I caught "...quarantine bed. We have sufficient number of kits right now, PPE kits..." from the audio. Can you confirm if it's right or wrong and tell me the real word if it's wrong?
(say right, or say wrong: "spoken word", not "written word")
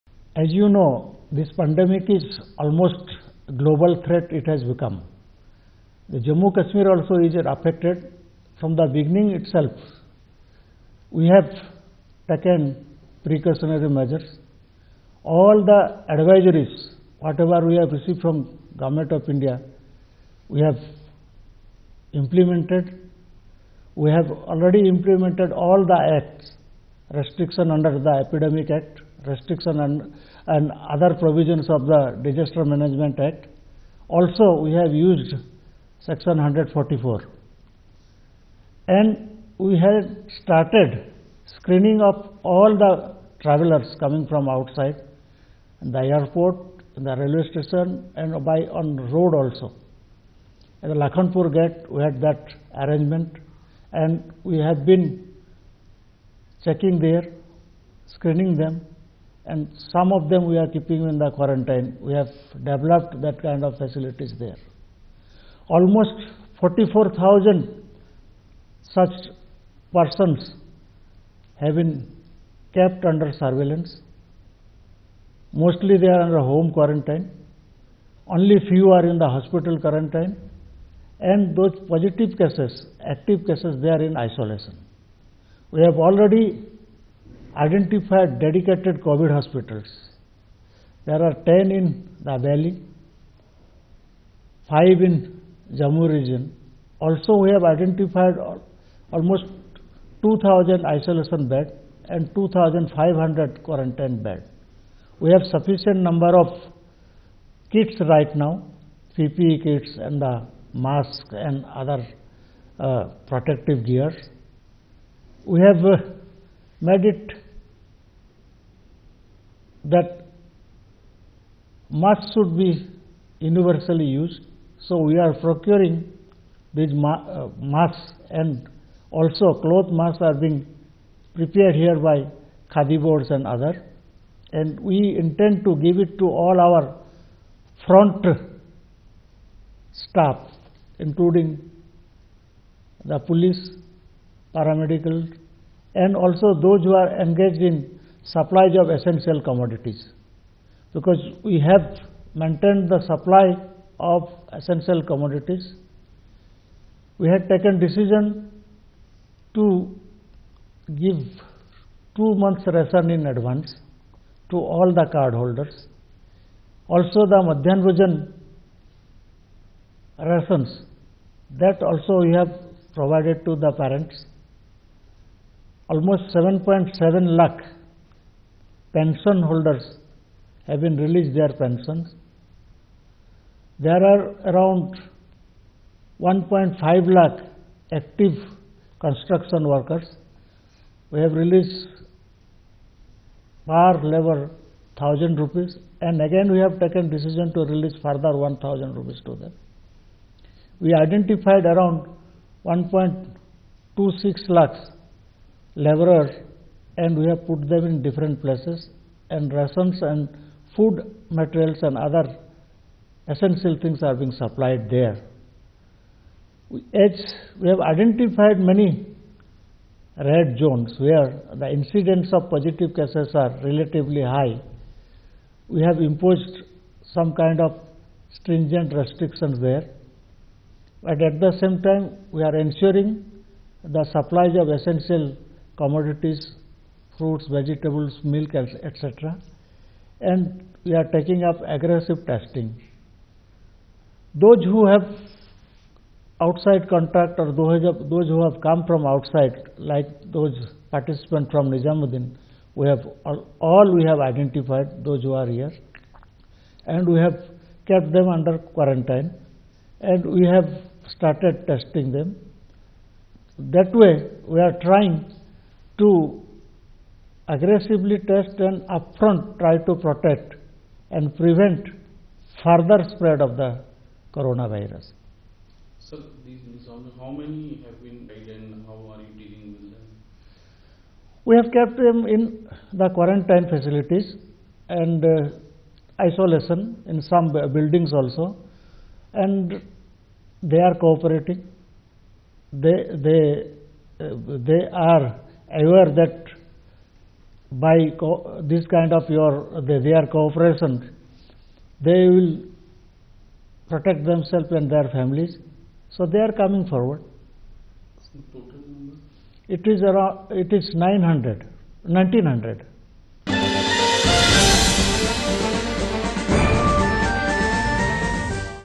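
right.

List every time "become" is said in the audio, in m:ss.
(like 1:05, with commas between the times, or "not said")
0:04.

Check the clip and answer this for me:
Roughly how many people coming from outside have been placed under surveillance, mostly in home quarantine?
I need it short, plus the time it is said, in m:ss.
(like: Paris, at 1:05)
44,000, at 1:06.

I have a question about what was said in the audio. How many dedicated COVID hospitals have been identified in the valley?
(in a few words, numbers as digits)
10.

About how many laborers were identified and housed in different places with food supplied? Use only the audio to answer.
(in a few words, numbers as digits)
1.26 lakh.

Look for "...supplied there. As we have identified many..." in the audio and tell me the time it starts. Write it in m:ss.
3:34.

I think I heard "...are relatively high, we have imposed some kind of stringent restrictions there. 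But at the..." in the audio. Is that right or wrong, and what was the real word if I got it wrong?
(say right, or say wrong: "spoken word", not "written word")
right.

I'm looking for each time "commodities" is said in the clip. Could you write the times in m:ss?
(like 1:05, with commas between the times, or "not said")
2:29, 2:35, 3:55.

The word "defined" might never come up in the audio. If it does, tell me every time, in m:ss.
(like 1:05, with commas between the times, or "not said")
not said.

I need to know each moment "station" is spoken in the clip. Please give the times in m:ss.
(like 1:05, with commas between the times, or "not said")
0:47.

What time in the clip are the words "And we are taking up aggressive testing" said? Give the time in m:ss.
4:00.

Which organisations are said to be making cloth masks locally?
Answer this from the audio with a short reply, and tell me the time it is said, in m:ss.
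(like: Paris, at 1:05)
Khadi boards, at 2:12.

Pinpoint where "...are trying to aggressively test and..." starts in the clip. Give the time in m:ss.
4:24.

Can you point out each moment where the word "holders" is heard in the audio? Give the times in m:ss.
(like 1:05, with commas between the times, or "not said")
2:45, 2:59.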